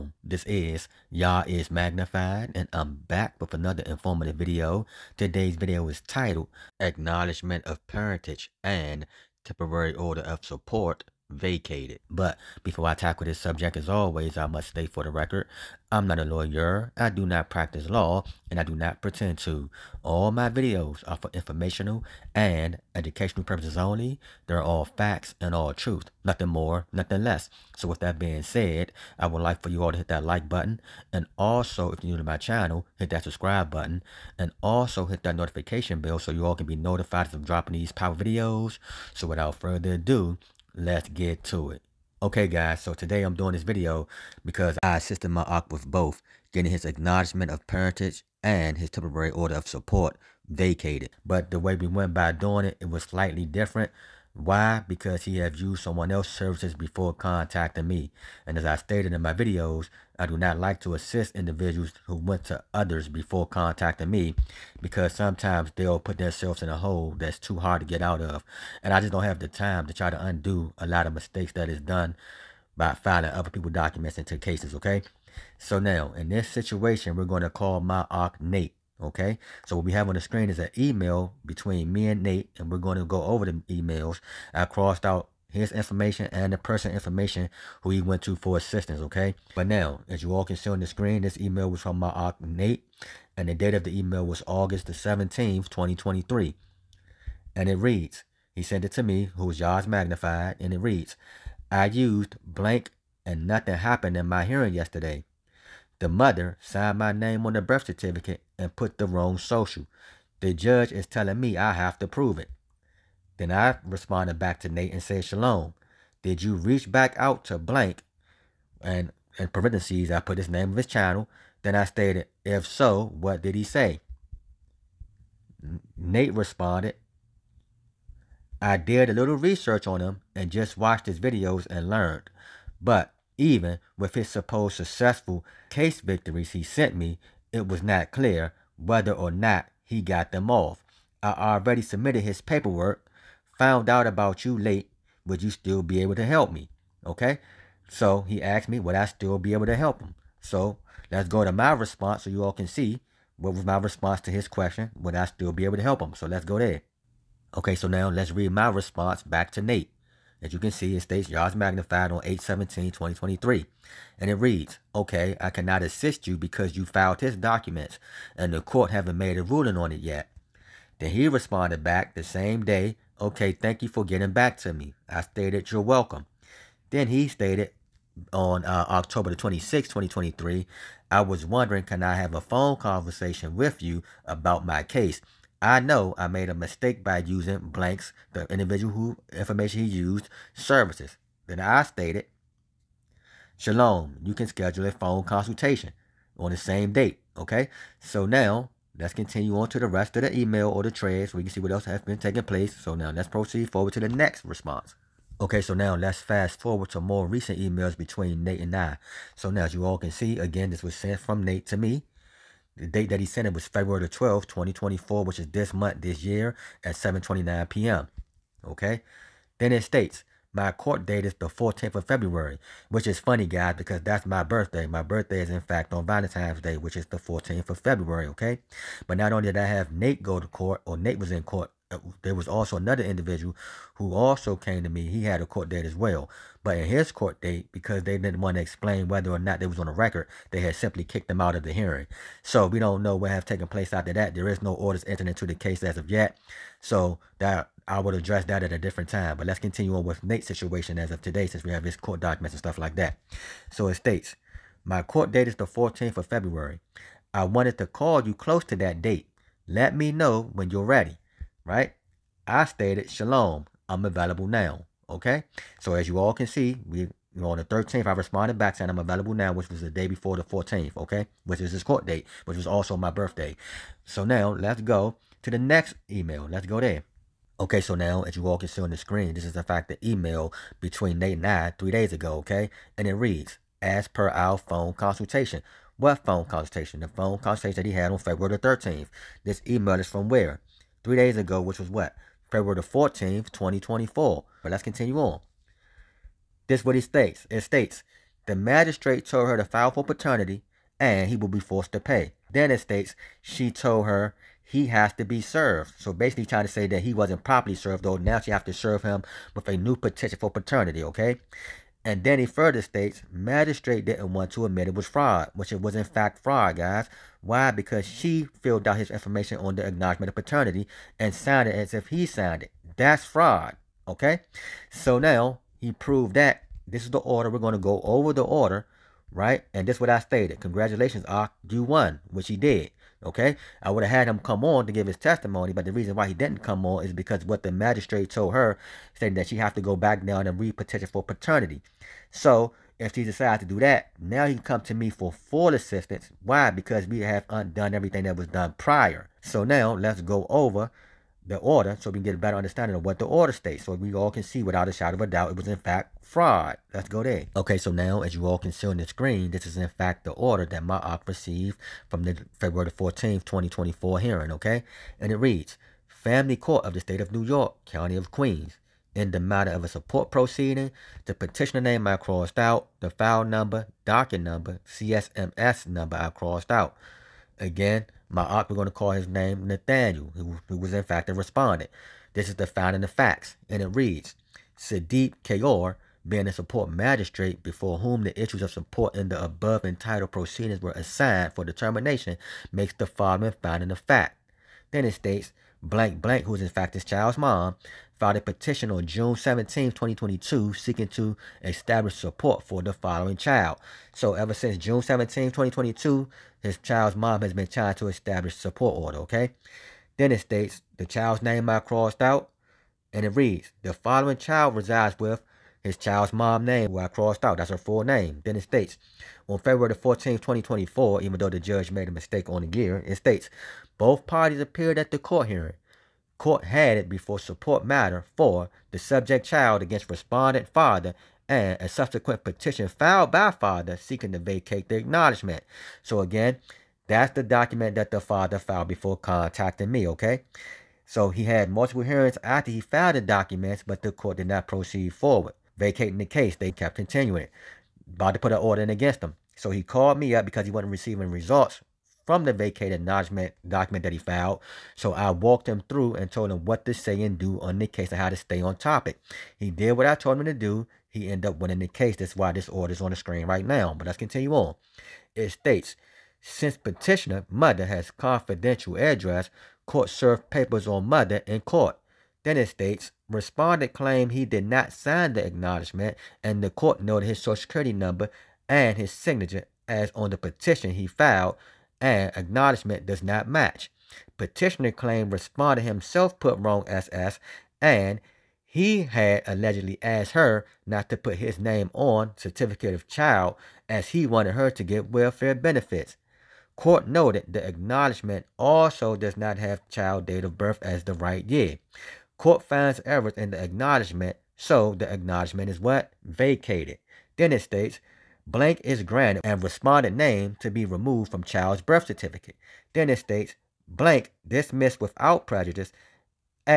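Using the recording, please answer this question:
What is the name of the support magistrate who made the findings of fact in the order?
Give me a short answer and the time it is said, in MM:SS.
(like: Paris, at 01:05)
Sadiq Kayor, at 06:24.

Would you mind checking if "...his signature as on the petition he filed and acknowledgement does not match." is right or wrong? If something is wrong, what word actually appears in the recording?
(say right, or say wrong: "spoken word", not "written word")
right.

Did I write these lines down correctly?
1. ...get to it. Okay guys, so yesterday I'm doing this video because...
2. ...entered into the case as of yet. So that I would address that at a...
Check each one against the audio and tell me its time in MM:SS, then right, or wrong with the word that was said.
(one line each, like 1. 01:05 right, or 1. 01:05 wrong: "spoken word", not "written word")
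1. 00:41 wrong: "today", not "yesterday"
2. 04:05 right.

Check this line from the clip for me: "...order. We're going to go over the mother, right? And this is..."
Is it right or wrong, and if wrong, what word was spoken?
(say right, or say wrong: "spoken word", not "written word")
wrong: "order", not "mother".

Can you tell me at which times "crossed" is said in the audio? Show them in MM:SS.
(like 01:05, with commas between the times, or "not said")
01:24, 06:12, 06:16, 06:51, 06:57.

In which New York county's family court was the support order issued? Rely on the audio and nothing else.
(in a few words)
Queens.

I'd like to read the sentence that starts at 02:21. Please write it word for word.
I already submitted his paperwork, found out about you late.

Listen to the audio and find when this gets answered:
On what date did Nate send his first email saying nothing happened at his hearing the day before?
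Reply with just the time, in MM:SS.
01:34.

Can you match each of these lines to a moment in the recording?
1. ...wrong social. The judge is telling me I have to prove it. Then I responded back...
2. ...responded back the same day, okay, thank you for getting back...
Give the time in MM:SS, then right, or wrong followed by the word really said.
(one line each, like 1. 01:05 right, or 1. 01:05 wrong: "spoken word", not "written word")
1. 01:49 right
2. 02:51 right.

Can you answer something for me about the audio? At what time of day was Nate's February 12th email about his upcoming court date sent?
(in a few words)
7:29 p.m.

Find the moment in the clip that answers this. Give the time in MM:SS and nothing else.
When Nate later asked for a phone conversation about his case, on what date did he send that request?
02:58.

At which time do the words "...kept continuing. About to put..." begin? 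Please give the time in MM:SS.
07:26.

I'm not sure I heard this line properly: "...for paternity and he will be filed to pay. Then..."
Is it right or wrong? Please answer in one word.
wrong.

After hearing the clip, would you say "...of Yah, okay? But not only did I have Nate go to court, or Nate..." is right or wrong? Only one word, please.
wrong.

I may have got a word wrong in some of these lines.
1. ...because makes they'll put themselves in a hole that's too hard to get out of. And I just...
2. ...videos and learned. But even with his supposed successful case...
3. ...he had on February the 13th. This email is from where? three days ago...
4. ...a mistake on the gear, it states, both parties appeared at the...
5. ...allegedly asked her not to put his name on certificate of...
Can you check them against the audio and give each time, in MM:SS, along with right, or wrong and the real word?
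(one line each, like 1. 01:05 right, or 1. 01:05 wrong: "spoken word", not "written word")
1. 01:04 wrong: "sometimes", not "makes"
2. 02:11 right
3. 04:47 right
4. 07:02 right
5. 08:09 right.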